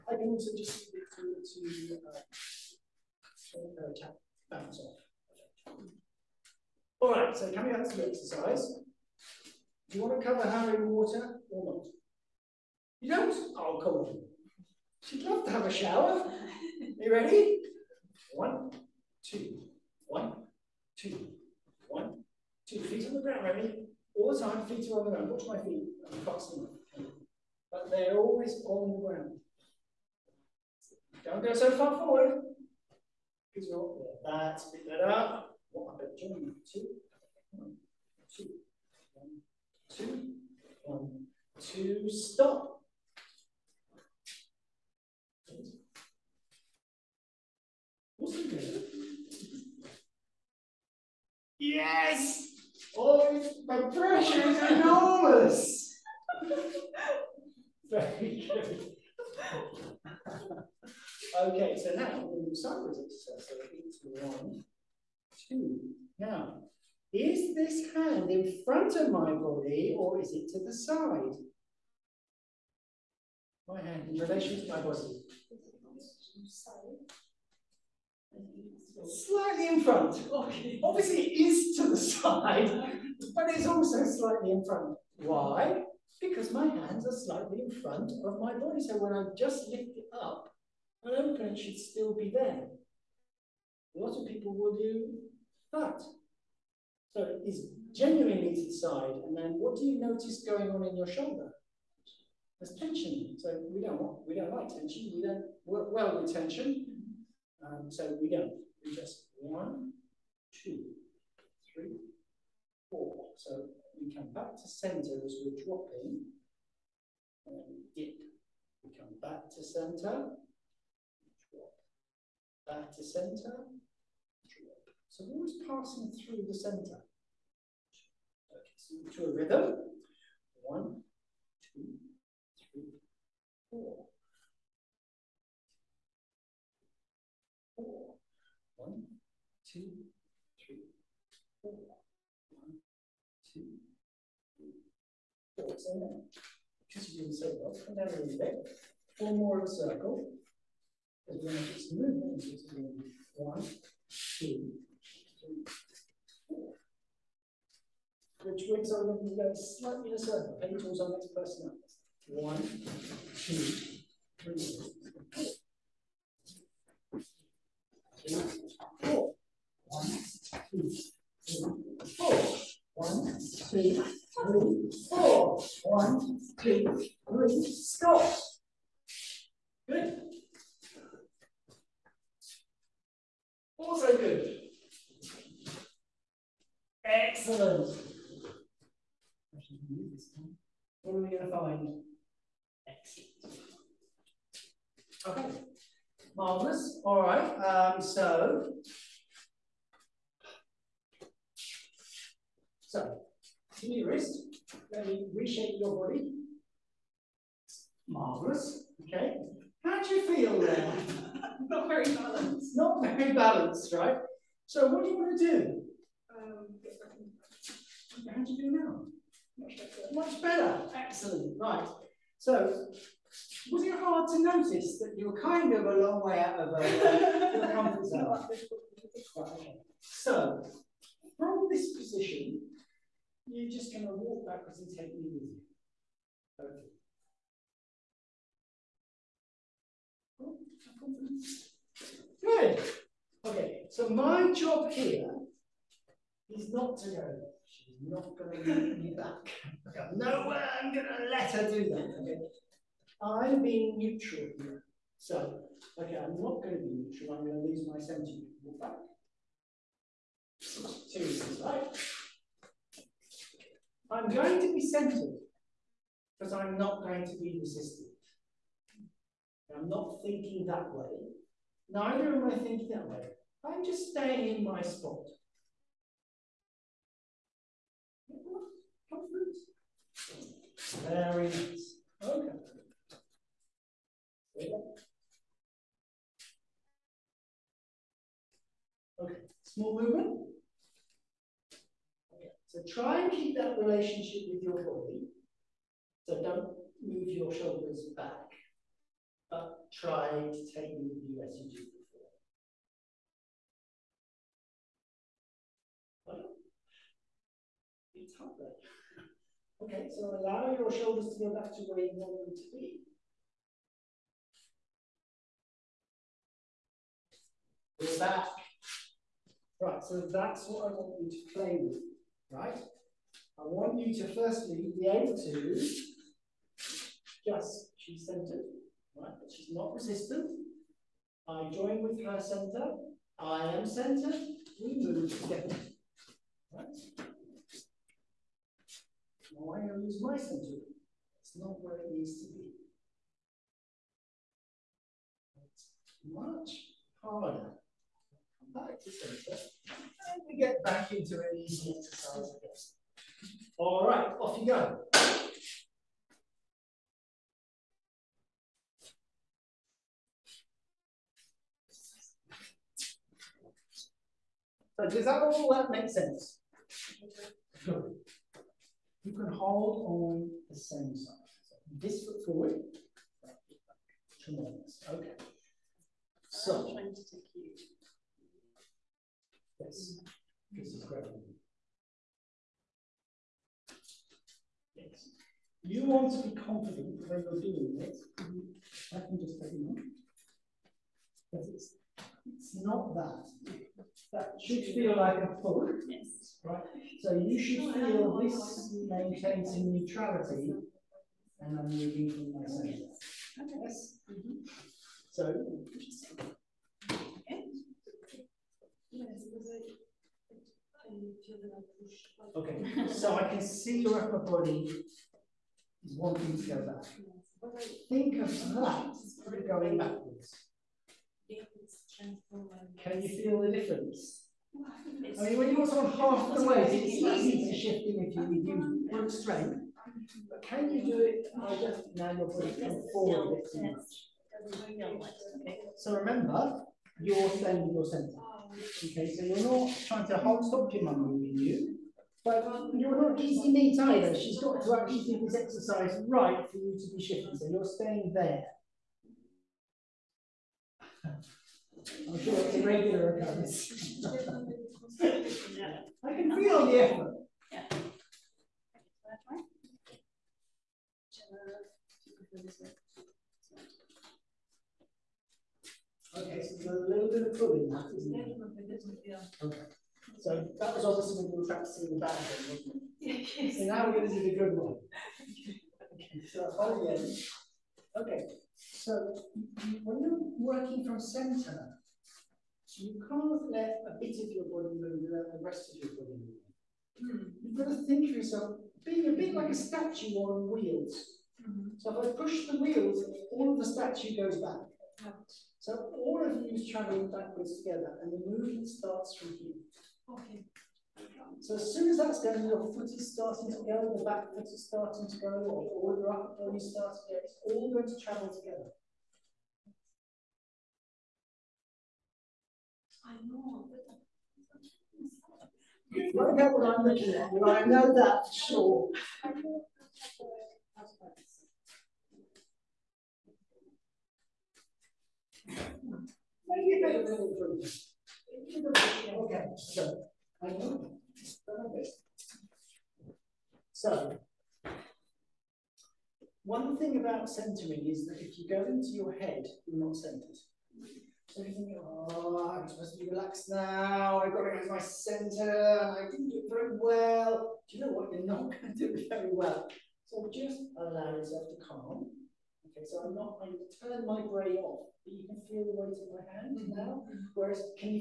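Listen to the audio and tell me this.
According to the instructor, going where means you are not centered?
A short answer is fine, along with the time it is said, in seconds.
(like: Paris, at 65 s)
Into your head, at 538 s.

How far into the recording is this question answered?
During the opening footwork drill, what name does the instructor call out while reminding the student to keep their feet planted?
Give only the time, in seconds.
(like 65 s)
23 s.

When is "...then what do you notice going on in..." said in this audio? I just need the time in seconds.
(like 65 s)
99 s.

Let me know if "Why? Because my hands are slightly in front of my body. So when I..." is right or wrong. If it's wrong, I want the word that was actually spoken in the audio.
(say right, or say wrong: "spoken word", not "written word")
right.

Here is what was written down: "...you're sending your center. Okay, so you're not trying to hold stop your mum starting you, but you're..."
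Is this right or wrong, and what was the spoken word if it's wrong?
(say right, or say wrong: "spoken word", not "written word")
wrong: "moving", not "starting".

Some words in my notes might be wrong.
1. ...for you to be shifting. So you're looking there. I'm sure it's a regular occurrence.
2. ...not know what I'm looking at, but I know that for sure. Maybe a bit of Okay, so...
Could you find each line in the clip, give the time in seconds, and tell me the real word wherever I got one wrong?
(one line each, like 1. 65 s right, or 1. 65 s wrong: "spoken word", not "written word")
1. 446 s wrong: "staying", not "looking"
2. 516 s right.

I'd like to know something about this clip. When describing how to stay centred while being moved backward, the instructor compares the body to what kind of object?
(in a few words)
A statue on wheels.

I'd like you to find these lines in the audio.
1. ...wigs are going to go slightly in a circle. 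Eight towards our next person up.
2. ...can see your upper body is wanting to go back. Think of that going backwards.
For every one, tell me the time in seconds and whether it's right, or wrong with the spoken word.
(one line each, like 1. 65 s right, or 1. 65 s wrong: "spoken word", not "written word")
1. 158 s right
2. 413 s right.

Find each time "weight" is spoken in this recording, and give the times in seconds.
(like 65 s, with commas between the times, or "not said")
426 s, 556 s.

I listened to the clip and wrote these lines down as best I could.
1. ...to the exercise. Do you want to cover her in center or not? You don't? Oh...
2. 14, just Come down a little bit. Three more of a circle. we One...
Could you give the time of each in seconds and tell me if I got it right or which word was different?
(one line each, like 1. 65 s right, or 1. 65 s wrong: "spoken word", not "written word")
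1. 7 s wrong: "water", not "center"
2. 145 s wrong: "Four", not "Three".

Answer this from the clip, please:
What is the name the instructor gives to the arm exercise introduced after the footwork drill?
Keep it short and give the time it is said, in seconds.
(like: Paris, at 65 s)
Cypress exercise, at 62 s.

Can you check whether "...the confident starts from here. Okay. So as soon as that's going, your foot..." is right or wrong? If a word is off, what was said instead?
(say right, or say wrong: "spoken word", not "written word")
wrong: "movement", not "confident".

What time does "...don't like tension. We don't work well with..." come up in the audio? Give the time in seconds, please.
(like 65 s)
104 s.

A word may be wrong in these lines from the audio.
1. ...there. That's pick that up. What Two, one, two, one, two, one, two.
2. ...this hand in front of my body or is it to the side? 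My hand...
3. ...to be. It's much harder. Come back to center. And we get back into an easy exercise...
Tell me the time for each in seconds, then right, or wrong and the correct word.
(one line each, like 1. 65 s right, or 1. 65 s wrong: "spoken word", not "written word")
1. 34 s right
2. 67 s right
3. 342 s right.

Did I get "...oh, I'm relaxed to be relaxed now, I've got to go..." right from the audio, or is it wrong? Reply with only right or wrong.
wrong.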